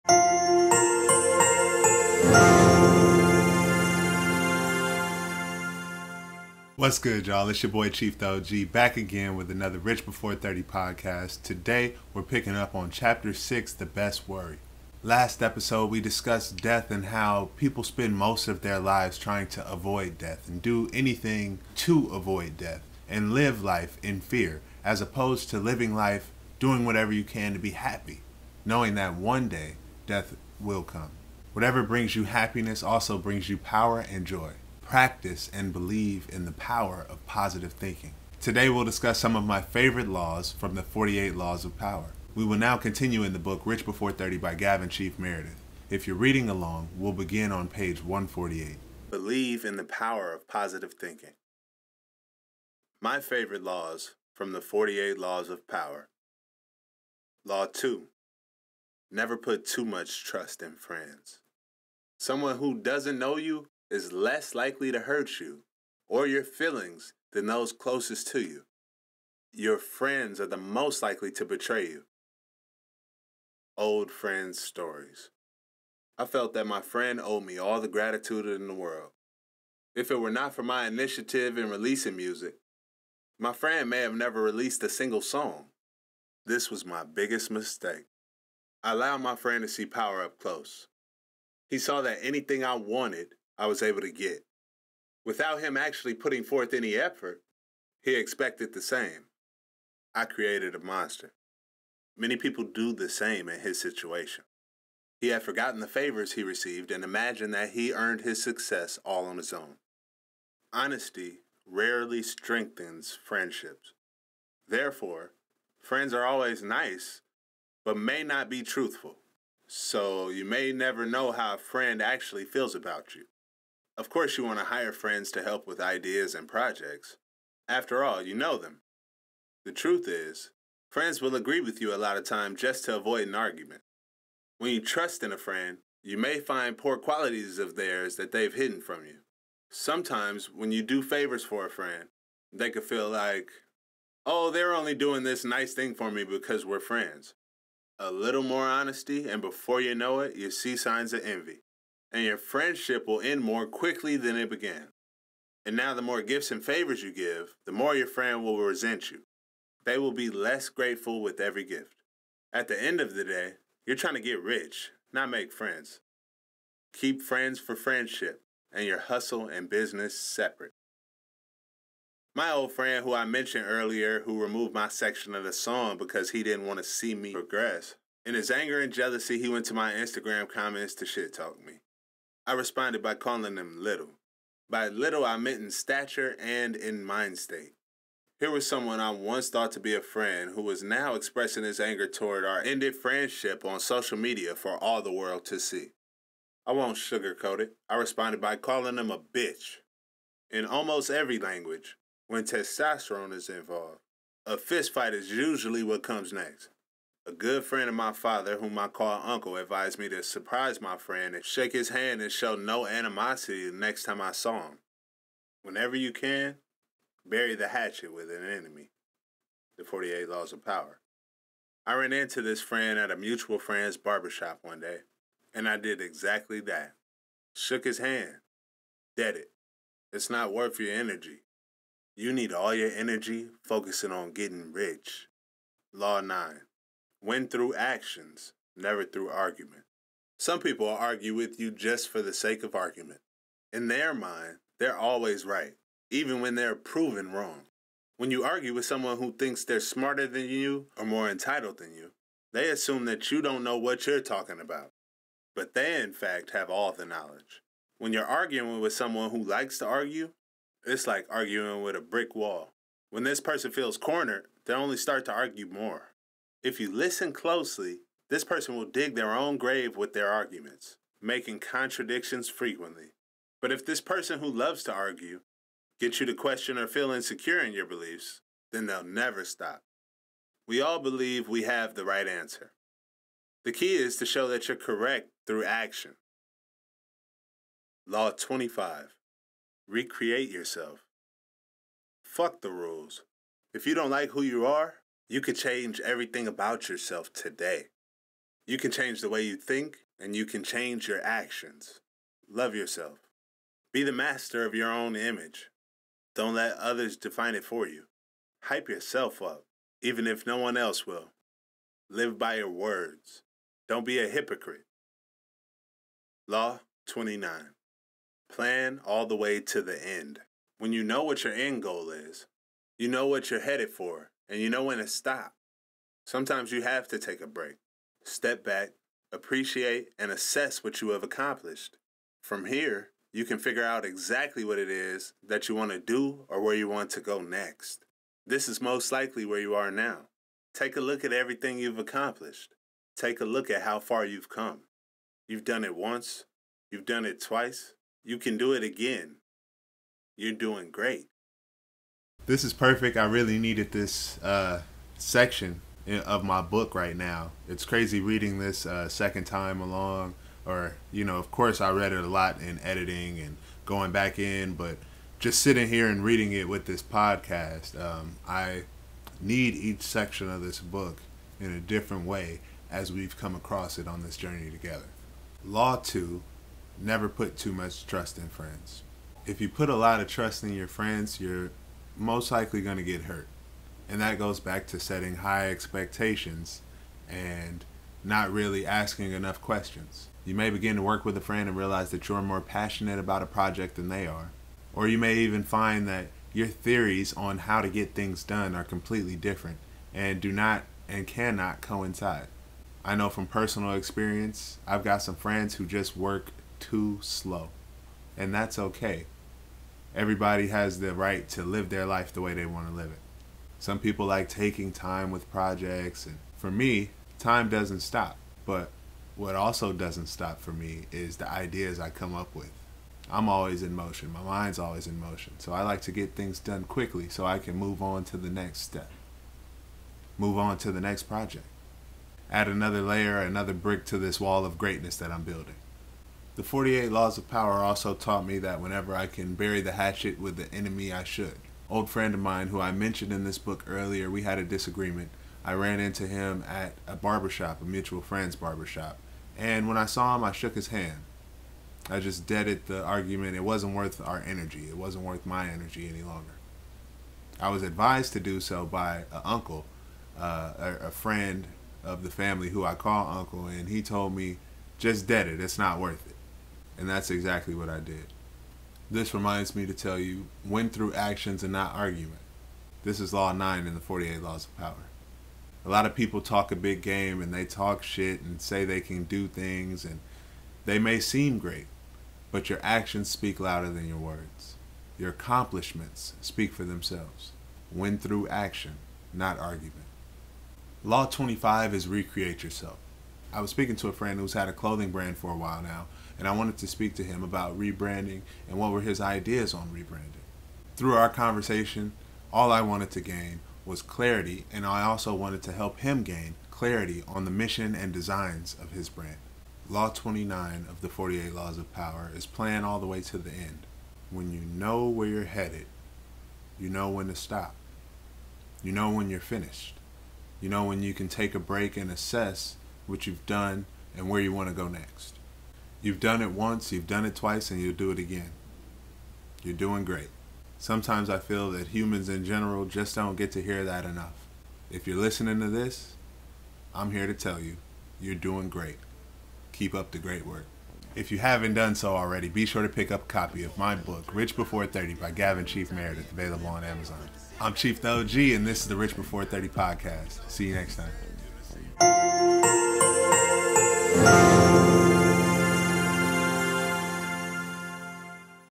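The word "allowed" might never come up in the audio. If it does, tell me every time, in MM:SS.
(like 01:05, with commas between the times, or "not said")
01:28.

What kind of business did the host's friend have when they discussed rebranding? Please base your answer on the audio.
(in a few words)
A clothing brand.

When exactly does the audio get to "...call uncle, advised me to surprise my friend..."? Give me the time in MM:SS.
03:28.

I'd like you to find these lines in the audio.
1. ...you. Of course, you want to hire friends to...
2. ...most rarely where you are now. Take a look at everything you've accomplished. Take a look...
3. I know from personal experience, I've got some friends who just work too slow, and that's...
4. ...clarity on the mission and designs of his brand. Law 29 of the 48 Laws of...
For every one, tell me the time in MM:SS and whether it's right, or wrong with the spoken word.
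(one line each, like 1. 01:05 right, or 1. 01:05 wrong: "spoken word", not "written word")
1. 02:03 right
2. 05:38 wrong: "likely", not "rarely"
3. 06:43 right
4. 08:26 right.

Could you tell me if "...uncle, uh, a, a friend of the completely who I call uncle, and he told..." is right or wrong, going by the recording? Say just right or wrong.
wrong.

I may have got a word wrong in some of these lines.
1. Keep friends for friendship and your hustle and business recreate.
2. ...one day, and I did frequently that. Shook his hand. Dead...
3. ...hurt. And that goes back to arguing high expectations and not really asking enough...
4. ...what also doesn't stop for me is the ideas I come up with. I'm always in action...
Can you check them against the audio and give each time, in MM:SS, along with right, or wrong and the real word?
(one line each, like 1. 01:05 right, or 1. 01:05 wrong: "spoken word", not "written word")
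1. 02:46 wrong: "separate", not "recreate"
2. 03:44 wrong: "exactly", not "frequently"
3. 06:23 wrong: "setting", not "arguing"
4. 06:59 wrong: "motion", not "action".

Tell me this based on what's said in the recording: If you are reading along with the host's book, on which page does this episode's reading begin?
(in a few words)
148.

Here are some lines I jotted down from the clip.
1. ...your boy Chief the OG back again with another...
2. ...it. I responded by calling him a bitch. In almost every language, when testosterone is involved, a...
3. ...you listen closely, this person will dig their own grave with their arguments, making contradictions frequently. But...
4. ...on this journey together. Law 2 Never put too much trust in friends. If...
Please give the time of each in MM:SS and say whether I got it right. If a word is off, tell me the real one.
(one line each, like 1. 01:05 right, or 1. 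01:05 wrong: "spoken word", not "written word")
1. 00:07 right
2. 03:17 right
3. 04:26 right
4. 06:14 right.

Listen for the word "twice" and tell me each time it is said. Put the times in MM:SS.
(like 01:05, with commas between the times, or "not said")
05:47, 08:47.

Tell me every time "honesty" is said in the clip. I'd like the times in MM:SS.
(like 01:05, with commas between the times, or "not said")
01:50, 02:28.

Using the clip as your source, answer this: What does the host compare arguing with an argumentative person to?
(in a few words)
A brick wall.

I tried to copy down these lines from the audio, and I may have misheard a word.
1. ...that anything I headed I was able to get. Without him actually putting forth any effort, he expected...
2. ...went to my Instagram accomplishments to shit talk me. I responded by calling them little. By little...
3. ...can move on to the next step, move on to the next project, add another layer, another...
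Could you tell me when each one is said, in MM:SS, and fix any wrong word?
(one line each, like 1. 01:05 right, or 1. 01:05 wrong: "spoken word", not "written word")
1. 01:32 wrong: "wanted", not "headed"
2. 02:59 wrong: "comments", not "accomplishments"
3. 07:07 right.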